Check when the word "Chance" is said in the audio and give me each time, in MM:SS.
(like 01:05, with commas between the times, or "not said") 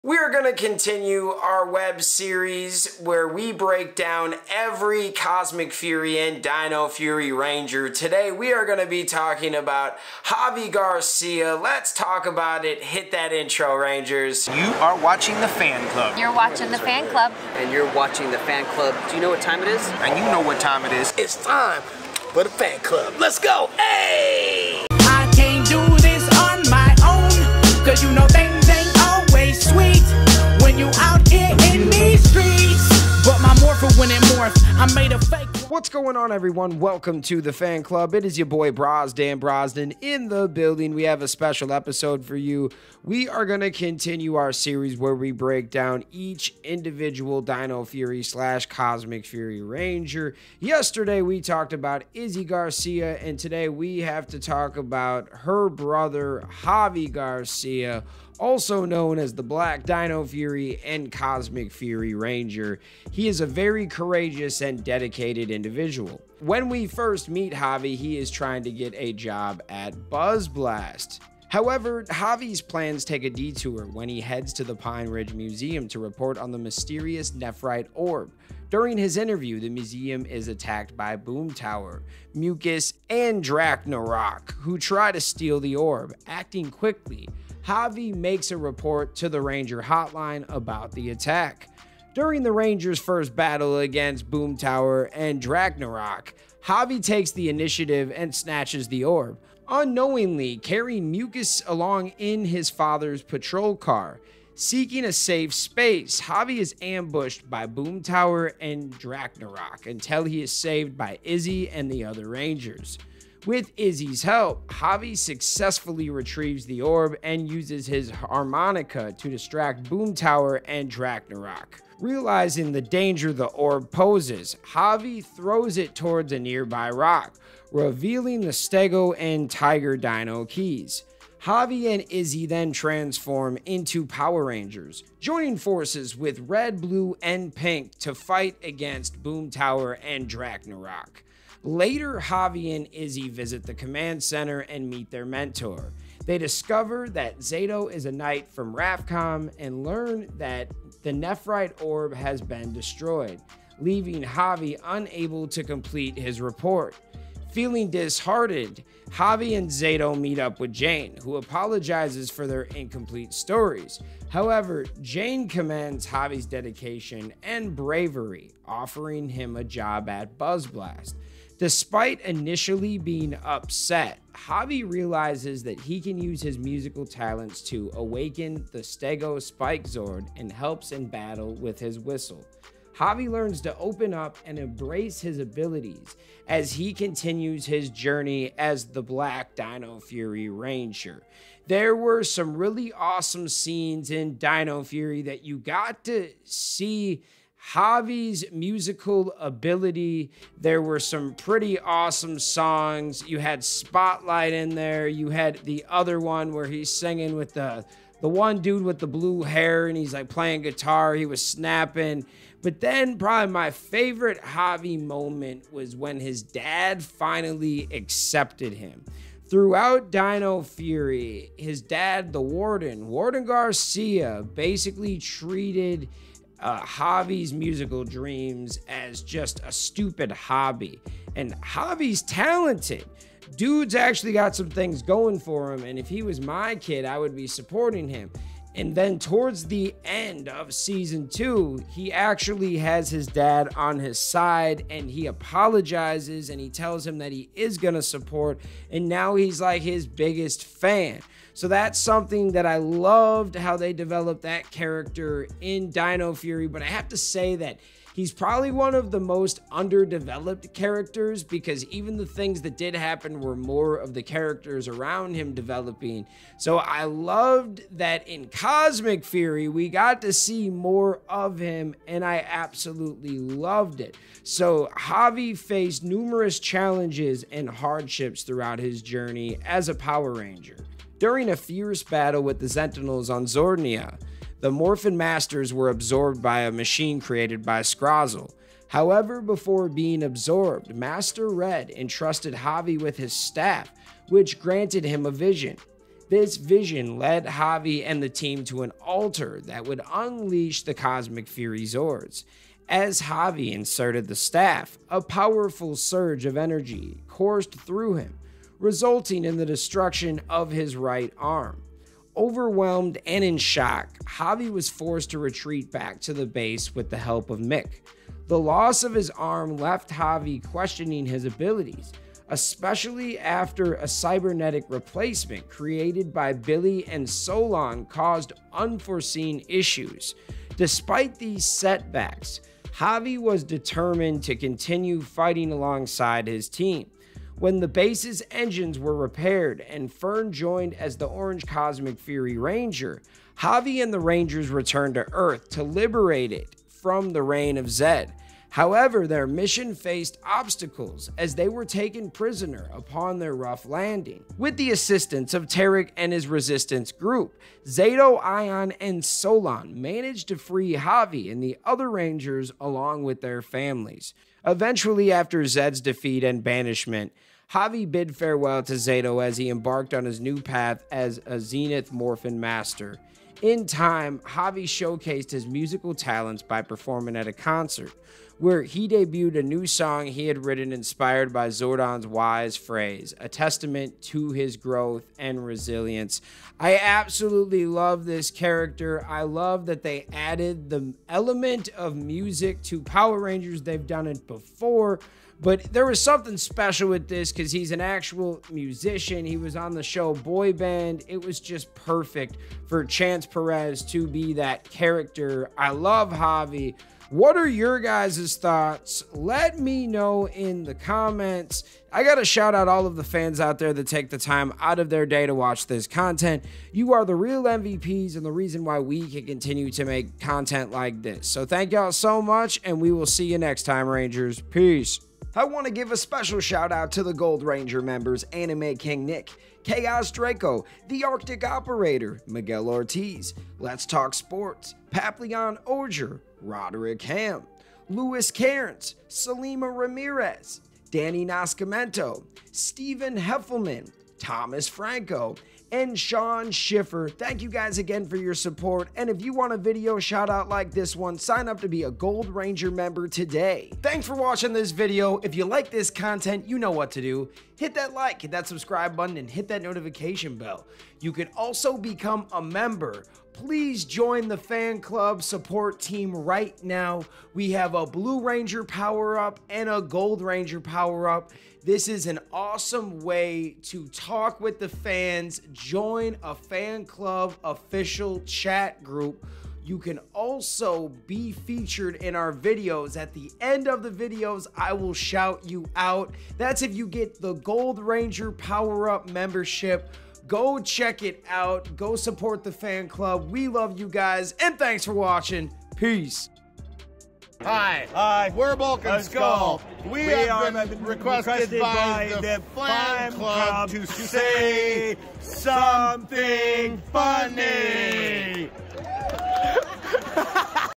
06:43.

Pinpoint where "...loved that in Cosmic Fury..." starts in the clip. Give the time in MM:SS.
04:27.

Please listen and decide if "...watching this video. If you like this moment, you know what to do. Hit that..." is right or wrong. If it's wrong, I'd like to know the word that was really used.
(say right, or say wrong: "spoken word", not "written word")
wrong: "content", not "moment".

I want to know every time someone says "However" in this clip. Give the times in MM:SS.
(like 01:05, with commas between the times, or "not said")
01:11, 02:44, 04:48, 05:48.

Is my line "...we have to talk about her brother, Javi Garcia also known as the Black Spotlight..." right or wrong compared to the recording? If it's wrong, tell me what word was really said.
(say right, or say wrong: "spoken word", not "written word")
wrong: "Dino", not "Spotlight".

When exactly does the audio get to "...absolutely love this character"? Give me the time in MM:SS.
06:26.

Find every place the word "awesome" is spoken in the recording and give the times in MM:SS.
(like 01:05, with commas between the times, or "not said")
03:12, 03:21, 07:52.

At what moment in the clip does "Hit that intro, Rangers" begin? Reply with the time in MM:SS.
00:12.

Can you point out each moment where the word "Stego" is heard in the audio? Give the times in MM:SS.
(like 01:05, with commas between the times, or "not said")
02:08, 02:58.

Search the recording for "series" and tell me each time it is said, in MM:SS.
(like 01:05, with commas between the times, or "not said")
00:02, 00:44.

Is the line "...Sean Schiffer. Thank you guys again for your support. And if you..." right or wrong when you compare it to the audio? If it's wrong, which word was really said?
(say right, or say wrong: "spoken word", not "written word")
right.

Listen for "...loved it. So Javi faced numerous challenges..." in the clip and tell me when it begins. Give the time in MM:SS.
04:33.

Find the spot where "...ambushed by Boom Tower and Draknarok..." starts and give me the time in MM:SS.
01:46.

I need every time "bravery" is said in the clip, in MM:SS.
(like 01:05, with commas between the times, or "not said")
02:47.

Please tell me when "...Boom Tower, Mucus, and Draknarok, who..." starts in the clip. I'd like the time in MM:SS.
01:21.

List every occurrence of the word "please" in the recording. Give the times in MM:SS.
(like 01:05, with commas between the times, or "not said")
07:43.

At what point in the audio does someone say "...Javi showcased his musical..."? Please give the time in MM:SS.
06:14.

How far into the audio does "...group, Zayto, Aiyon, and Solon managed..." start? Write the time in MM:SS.
05:57.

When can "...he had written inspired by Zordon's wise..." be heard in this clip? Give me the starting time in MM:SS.
06:20.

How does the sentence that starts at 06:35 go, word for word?
But there was something special with this because he's an actual musician.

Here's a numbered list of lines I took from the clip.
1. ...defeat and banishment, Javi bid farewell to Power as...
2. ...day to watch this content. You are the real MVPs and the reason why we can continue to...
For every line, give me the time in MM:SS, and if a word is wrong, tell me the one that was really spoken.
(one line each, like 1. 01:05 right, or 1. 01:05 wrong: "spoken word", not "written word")
1. 06:06 wrong: "Zayto", not "Power"
2. 06:55 right.